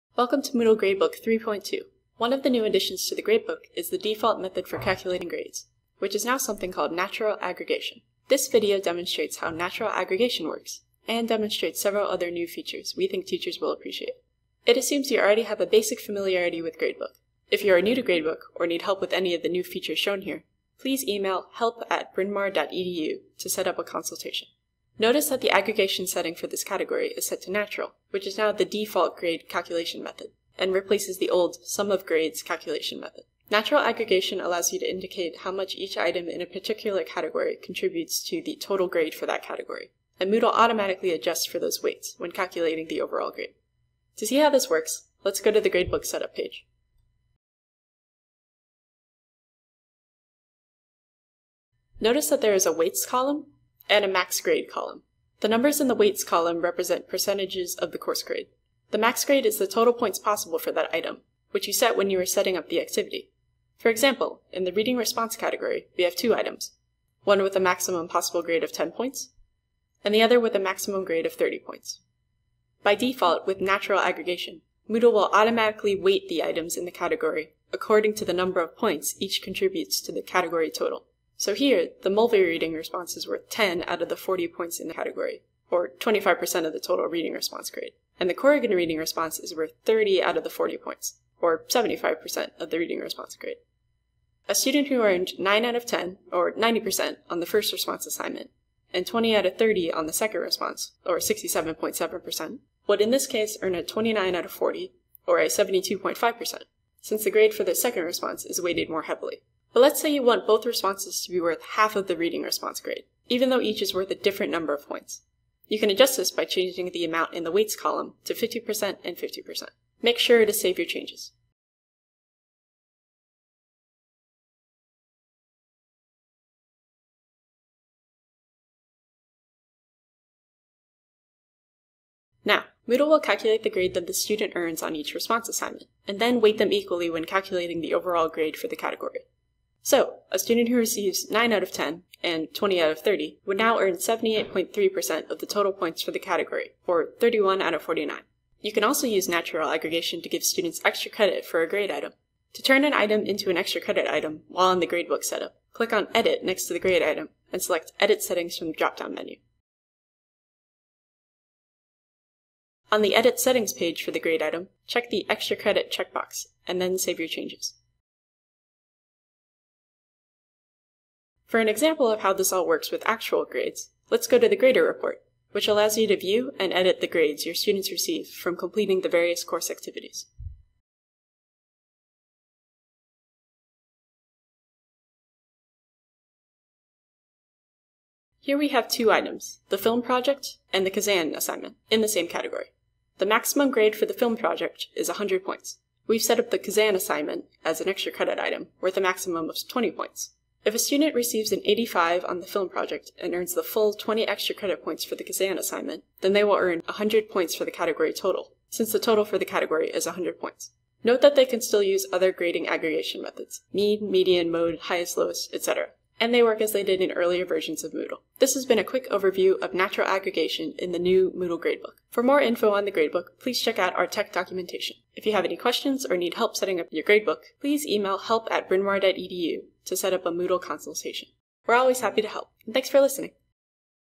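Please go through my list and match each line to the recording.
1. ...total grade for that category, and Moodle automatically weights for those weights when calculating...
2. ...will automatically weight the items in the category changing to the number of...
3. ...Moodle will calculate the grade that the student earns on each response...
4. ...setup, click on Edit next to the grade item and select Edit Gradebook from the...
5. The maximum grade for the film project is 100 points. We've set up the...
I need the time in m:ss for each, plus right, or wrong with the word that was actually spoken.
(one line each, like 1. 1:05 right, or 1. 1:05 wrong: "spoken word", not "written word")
1. 0:38 wrong: "adjusts", not "weights"
2. 1:15 wrong: "according", not "changing"
3. 2:12 right
4. 2:35 wrong: "Settings", not "Gradebook"
5. 3:13 right.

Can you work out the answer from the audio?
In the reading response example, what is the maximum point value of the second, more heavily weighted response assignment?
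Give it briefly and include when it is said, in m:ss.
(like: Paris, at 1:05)
30 points, at 1:11.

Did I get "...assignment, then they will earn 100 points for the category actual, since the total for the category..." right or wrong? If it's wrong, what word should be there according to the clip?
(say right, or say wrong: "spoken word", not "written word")
wrong: "total", not "actual".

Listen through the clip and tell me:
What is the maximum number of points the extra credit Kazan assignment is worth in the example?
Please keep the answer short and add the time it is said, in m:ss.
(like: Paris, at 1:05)
20 points, at 3:19.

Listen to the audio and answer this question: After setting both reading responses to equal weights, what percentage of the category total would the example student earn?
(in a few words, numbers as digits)
78.3%.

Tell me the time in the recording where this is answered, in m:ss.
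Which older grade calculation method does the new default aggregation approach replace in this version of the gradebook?
0:31.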